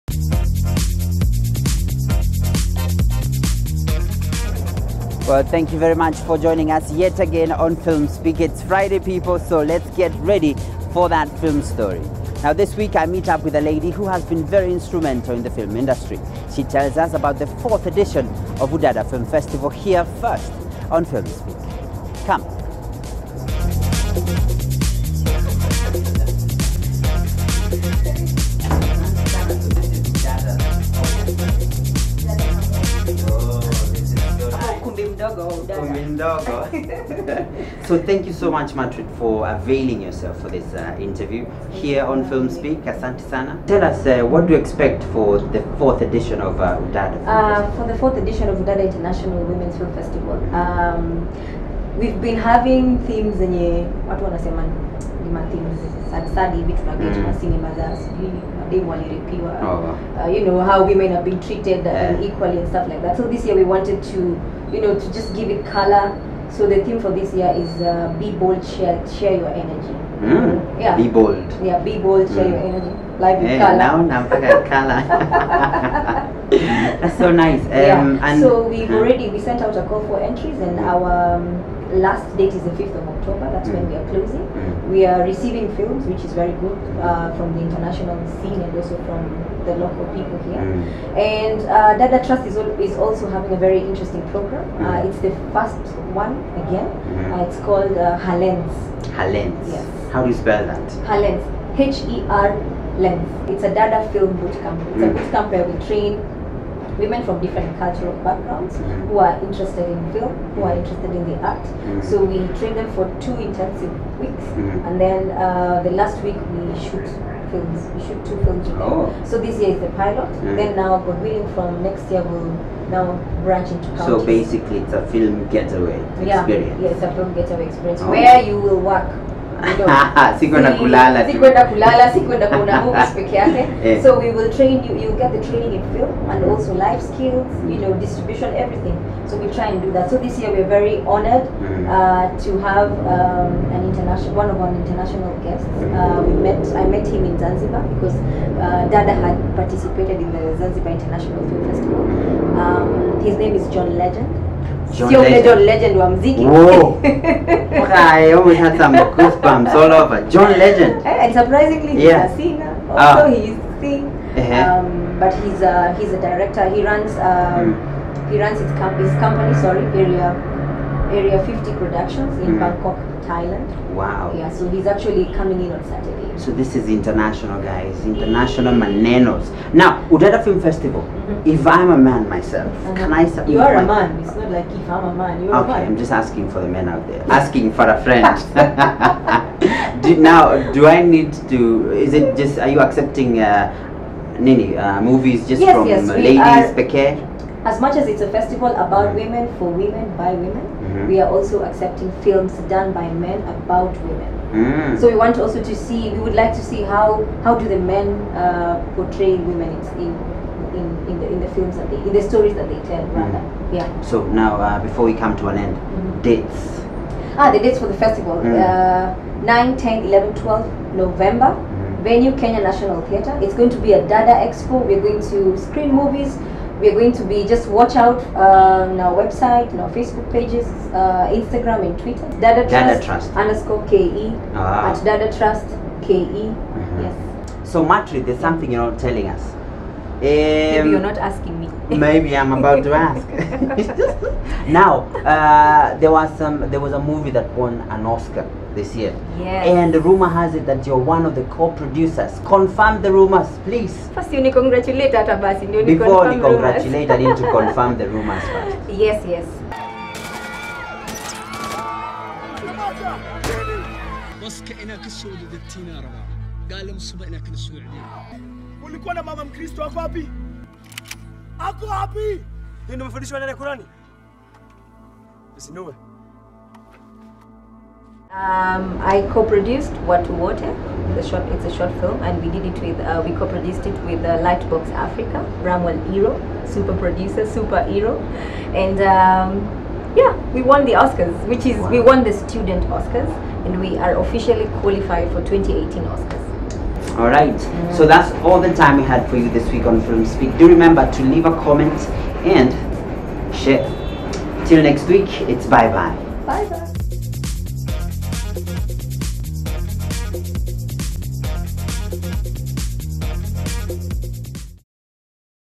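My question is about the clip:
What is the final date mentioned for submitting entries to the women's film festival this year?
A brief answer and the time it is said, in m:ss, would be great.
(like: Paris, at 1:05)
5th of October, at 1:22.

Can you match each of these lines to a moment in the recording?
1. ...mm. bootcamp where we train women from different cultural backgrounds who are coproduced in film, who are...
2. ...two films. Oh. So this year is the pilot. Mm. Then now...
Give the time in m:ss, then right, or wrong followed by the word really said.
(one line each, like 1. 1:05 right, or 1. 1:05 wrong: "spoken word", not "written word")
1. 1:45 wrong: "interested", not "coproduced"
2. 1:58 right.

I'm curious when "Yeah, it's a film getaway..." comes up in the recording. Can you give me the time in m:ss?
2:06.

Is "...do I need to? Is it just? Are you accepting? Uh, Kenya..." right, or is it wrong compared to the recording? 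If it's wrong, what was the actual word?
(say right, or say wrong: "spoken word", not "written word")
wrong: "Nini", not "Kenya".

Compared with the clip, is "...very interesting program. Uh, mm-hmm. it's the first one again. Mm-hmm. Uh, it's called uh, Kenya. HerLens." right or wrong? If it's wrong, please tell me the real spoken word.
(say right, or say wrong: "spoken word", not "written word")
wrong: "HerLens", not "Kenya".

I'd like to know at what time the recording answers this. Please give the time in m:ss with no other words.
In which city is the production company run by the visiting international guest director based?
2:52.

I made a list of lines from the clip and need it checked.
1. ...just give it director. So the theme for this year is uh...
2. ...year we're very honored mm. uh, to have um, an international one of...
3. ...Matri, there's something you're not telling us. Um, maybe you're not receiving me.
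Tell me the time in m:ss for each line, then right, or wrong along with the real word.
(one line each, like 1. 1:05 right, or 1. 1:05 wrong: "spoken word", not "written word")
1. 1:05 wrong: "color", not "director"
2. 2:20 right
3. 3:57 wrong: "asking", not "receiving".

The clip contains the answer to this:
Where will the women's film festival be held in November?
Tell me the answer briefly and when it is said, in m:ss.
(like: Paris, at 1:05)
Kenya National Theatre, at 3:42.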